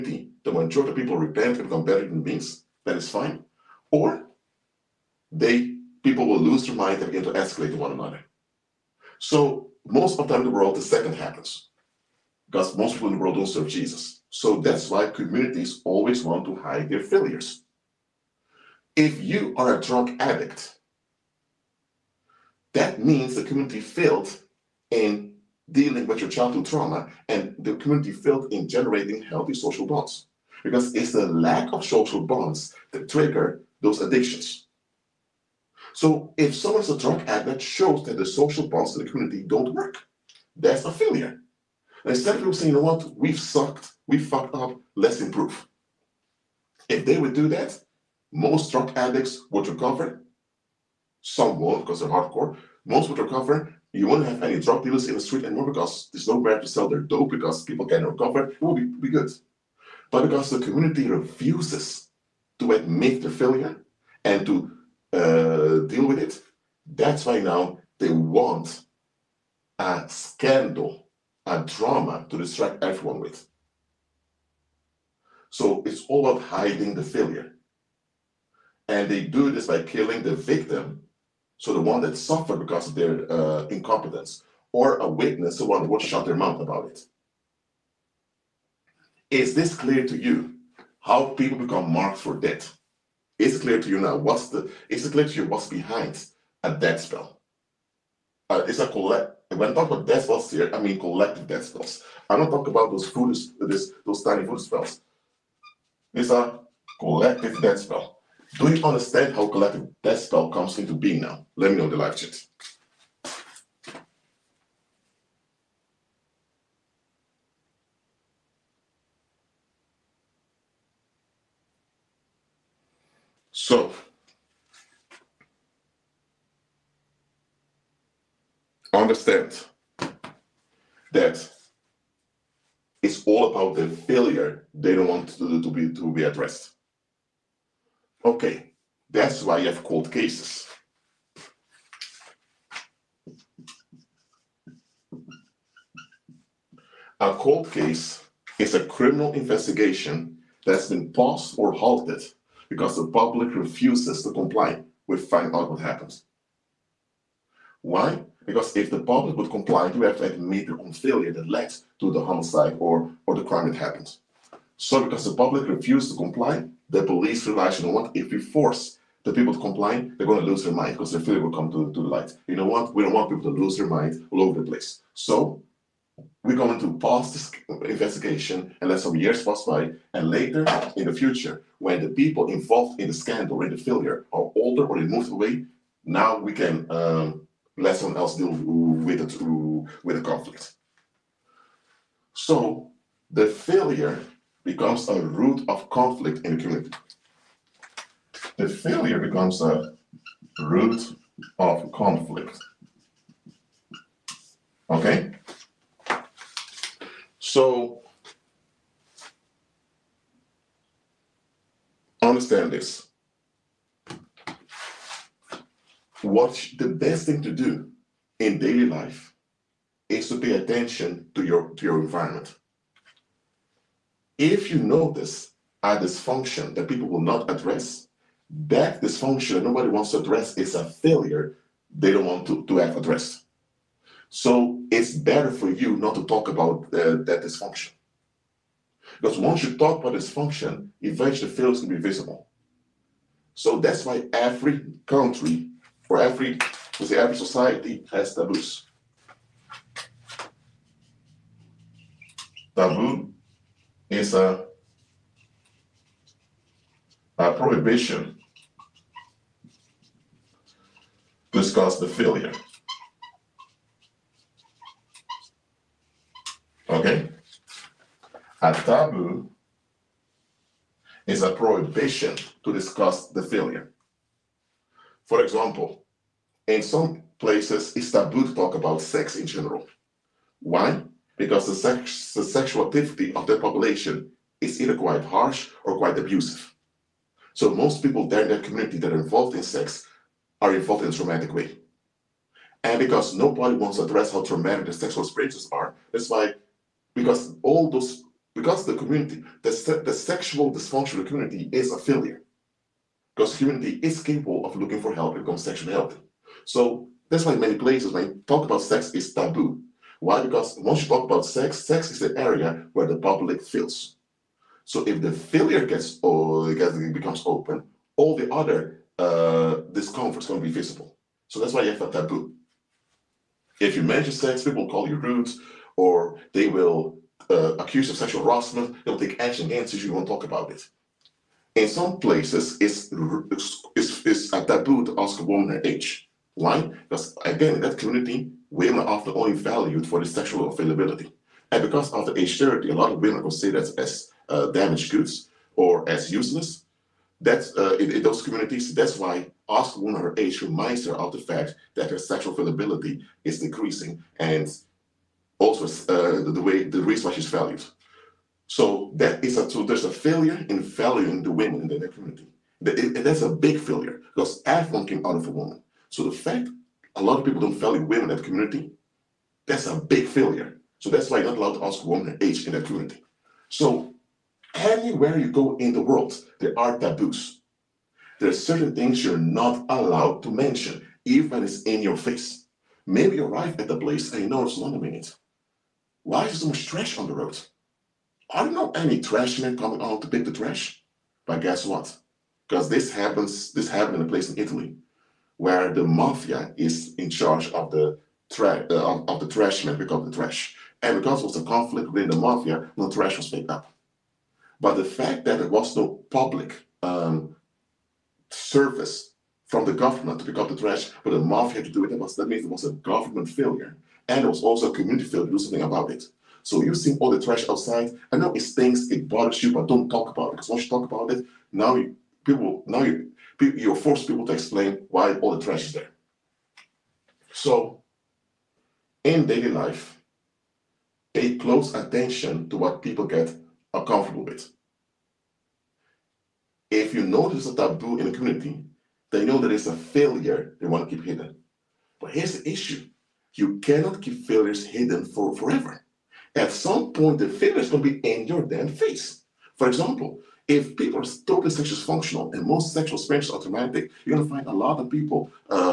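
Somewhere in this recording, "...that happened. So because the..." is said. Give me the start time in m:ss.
2:43.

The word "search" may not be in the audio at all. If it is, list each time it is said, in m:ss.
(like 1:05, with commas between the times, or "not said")
not said.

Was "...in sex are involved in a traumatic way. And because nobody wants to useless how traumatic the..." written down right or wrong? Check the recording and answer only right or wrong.
wrong.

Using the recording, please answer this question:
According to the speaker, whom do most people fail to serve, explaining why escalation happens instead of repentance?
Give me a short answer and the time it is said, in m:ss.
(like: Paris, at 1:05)
Jesus, at 0:13.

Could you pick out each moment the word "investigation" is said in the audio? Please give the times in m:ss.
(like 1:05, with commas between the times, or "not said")
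2:29, 2:57.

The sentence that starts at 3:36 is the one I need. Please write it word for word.
what the best thing to do in daily life is to pay attention to your to your environment.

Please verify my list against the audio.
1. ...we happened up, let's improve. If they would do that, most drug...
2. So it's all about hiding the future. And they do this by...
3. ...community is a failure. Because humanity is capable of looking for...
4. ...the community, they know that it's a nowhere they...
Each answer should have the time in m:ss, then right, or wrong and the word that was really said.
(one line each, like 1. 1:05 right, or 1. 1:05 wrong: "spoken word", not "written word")
1. 0:44 wrong: "fucked", not "happened"
2. 1:15 wrong: "failure", not "future"
3. 5:01 right
4. 7:18 wrong: "failure", not "nowhere".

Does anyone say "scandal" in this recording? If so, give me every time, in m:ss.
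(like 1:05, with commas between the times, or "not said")
1:10, 3:03.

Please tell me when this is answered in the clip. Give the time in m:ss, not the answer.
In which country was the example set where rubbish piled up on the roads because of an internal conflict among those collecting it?
6:34.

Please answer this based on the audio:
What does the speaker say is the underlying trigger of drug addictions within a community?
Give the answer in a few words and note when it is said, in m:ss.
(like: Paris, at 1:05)
Lack of social bonds, at 0:31.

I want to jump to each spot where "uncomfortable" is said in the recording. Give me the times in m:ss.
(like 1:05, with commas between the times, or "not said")
7:13.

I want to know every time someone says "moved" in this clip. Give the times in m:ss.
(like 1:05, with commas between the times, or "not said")
3:05.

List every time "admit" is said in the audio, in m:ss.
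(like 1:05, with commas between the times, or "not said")
1:02, 2:40.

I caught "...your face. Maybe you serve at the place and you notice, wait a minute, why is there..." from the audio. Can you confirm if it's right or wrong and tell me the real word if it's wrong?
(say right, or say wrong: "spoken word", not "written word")
wrong: "arrive", not "serve".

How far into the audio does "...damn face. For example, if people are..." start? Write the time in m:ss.
7:28.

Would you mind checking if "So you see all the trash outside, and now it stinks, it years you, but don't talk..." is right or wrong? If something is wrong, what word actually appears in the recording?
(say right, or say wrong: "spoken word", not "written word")
wrong: "bothers", not "years".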